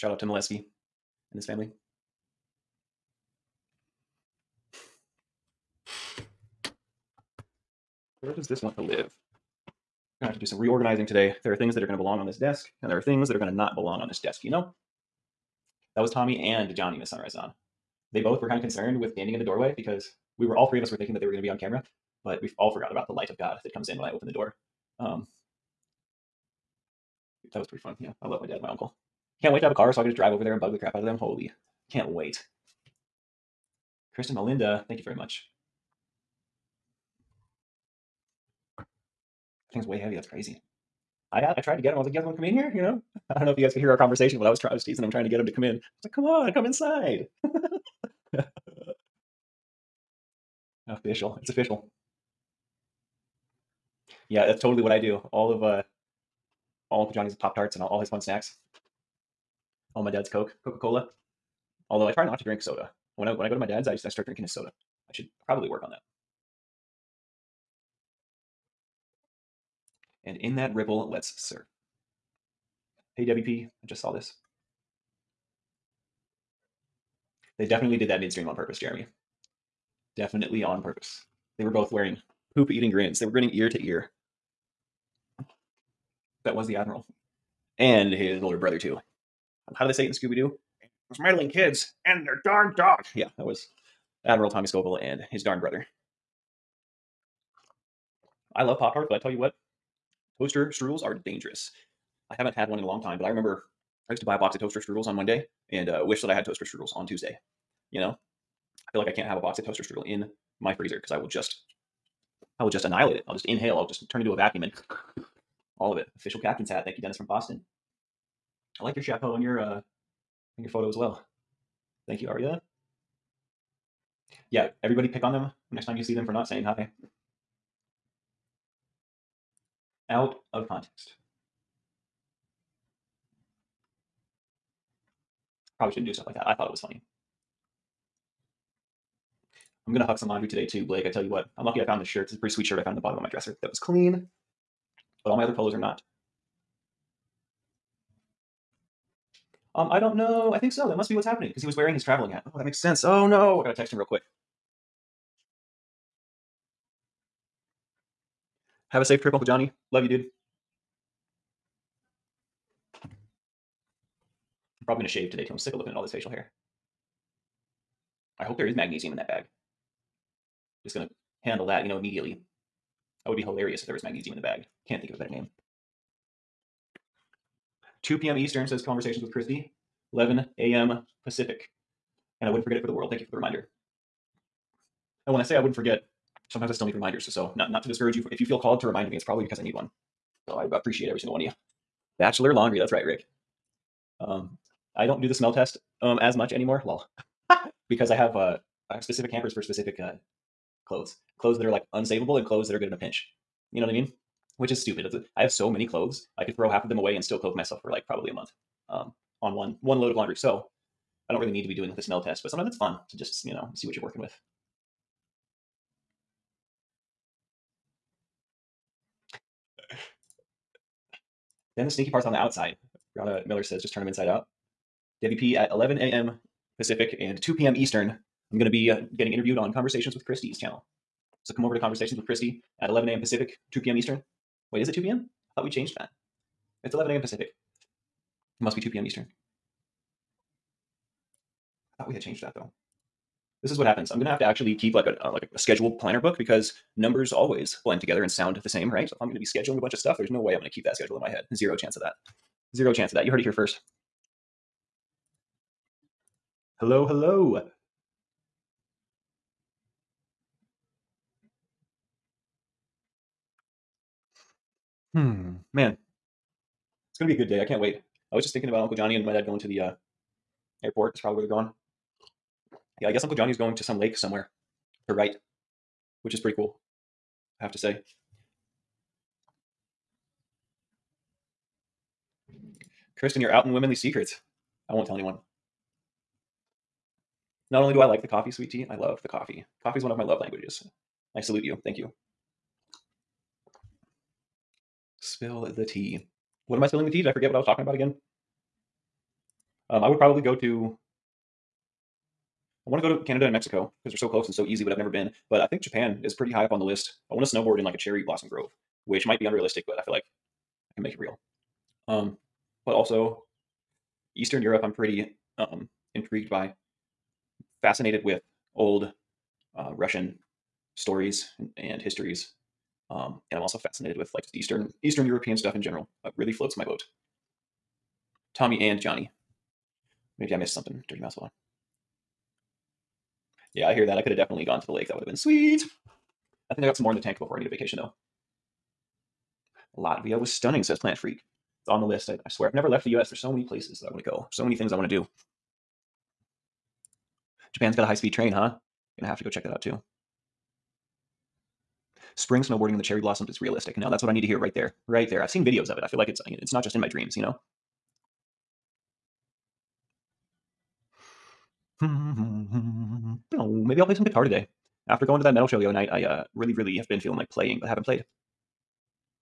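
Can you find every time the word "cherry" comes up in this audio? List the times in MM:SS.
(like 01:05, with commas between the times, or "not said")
05:07, 05:53.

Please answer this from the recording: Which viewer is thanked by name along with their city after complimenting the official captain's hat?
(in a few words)
Dennis from Boston.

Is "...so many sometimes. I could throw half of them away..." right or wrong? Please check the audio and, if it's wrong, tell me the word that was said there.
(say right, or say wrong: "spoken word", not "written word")
wrong: "clothes", not "sometimes".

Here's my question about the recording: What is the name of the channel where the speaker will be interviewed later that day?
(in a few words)
Conversations with Christy.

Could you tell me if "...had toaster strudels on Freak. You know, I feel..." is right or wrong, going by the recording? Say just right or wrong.
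wrong.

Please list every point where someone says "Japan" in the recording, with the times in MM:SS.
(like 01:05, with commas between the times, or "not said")
05:05, 05:47.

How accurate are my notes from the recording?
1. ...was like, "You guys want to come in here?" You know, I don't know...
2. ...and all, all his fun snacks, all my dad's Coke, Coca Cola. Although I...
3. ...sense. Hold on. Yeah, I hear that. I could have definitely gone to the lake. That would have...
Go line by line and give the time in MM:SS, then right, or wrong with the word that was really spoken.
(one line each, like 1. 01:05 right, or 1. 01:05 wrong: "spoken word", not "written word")
1. 00:41 right
2. 00:57 right
3. 05:31 wrong: "mouse", not "sense".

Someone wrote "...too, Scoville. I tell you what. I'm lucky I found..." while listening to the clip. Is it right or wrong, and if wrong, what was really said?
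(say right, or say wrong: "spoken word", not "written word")
wrong: "Blake", not "Scoville".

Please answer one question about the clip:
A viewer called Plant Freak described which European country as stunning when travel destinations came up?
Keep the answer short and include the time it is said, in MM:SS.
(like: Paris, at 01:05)
Latvia, at 05:39.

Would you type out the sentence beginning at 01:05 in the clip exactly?
I should probably work on that.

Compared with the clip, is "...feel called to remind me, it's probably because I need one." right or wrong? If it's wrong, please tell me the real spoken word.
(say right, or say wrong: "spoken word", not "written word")
right.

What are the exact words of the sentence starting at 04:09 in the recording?
So if I'm gonna be scheduling a bunch of stuff, there's no way I'm gonna keep that schedule in my head.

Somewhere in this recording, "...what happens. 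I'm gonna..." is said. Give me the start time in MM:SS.
04:03.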